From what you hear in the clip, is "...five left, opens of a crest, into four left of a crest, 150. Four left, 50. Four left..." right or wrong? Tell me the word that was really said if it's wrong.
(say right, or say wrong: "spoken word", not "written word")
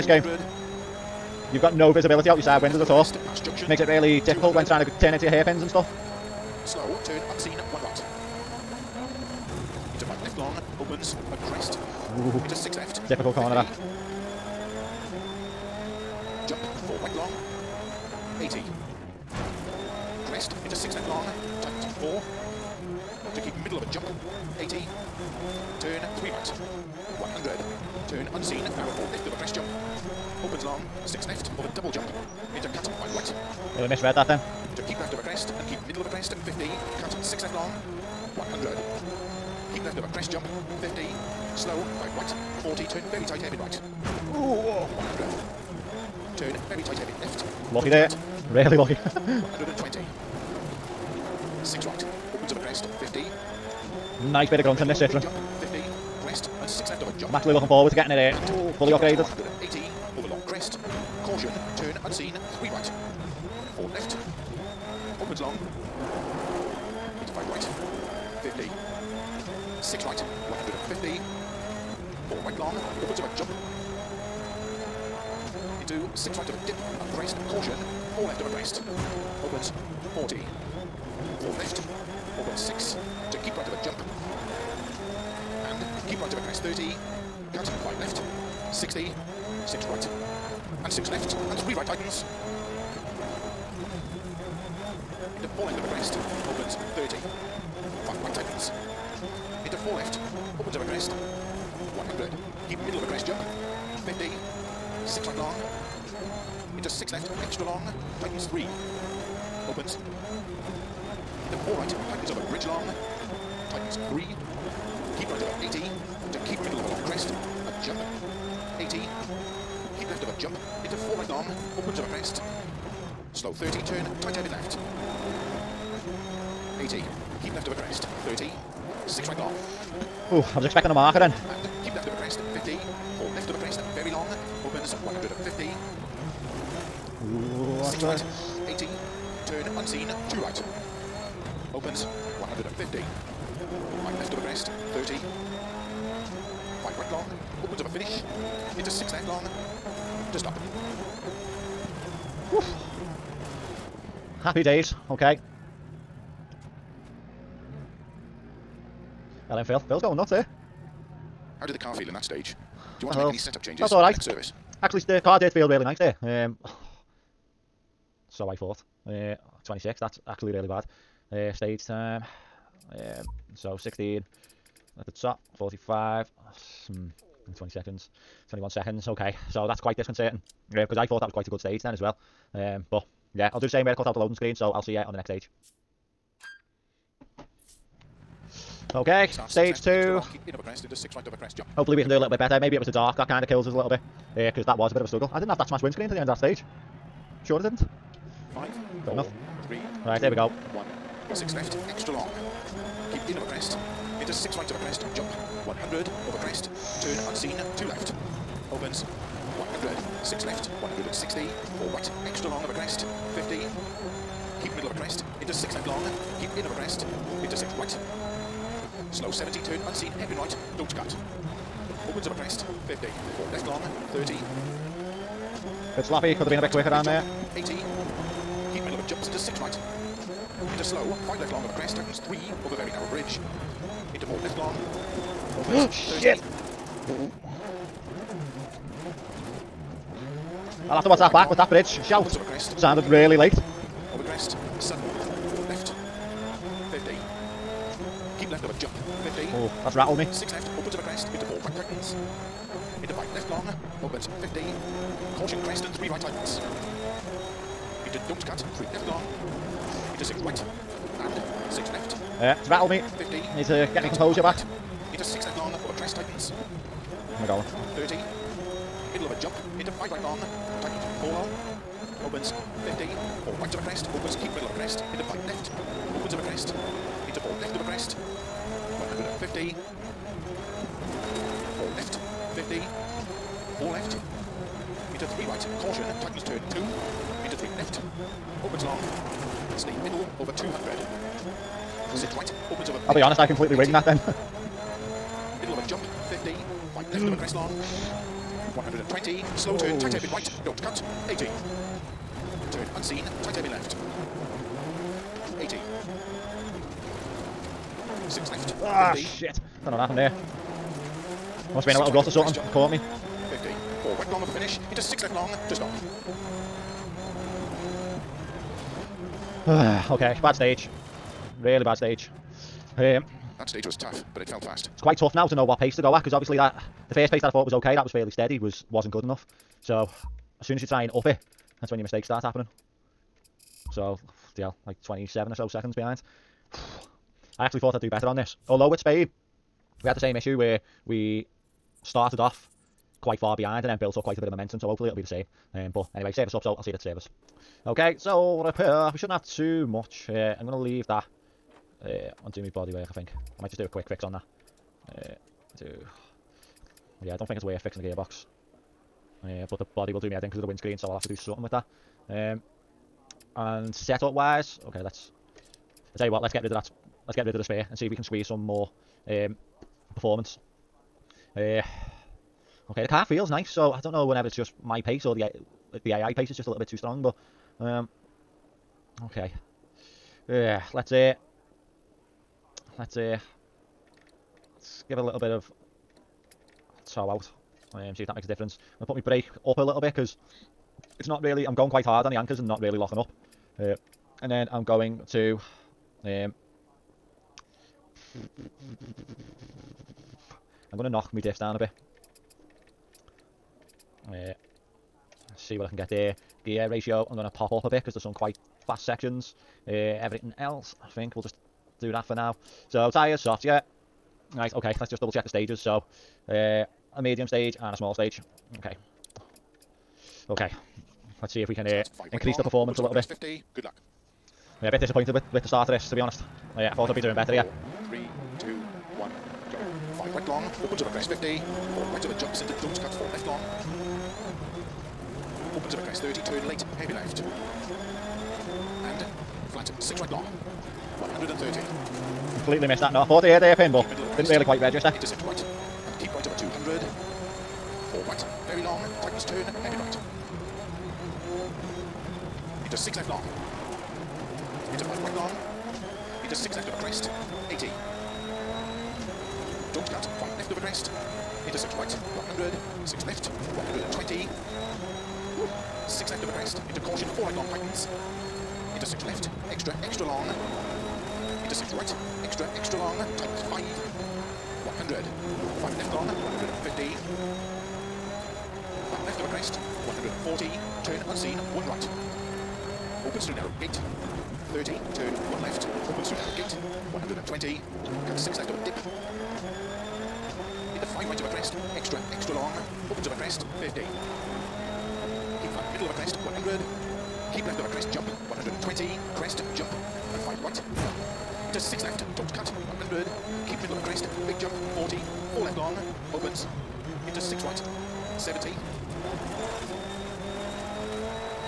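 right.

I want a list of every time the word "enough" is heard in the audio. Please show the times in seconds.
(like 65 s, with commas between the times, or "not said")
199 s, 329 s.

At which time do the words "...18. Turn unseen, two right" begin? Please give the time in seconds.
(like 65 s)
138 s.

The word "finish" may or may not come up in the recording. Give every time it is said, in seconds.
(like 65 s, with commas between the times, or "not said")
147 s, 314 s.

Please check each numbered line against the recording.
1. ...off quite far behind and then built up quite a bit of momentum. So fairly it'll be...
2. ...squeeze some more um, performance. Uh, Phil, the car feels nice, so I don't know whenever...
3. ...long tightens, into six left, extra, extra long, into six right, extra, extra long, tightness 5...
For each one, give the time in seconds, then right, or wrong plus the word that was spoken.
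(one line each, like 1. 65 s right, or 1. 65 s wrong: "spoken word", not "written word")
1. 342 s wrong: "hopefully", not "fairly"
2. 368 s wrong: "Okay", not "Phil"
3. 467 s right.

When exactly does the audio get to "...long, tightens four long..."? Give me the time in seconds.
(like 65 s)
270 s.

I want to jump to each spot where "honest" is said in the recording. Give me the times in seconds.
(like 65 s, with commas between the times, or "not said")
293 s, 426 s.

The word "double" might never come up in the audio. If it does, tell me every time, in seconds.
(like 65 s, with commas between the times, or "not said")
31 s, 415 s.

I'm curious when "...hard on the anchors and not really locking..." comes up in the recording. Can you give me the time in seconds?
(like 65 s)
392 s.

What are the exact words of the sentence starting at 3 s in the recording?
Makes it really difficult when trying to turn into your hairpins and stuff.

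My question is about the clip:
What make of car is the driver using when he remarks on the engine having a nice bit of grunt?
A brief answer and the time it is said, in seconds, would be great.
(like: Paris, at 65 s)
Citroen, at 54 s.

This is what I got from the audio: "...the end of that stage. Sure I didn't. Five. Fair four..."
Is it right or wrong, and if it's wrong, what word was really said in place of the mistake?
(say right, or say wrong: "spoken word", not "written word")
right.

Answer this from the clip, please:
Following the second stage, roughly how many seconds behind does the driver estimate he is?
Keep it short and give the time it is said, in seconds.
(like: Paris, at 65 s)
27, at 335 s.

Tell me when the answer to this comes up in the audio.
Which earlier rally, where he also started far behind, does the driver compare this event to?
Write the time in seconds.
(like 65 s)
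338 s.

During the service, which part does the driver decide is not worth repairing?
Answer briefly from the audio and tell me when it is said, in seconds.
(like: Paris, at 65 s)
gearbox, at 358 s.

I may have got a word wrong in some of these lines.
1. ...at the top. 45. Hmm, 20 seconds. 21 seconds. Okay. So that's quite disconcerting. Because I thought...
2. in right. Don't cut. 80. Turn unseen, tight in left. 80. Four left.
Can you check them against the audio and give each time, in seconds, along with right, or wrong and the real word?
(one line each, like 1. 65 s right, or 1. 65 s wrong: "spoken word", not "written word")
1. 174 s right
2. 300 s wrong: "Six", not "Four".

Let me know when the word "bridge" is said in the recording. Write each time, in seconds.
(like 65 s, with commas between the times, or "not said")
112 s, 233 s, 241 s.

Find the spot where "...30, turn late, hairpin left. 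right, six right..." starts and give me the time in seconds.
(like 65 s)
436 s.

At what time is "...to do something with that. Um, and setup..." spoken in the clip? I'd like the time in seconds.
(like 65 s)
361 s.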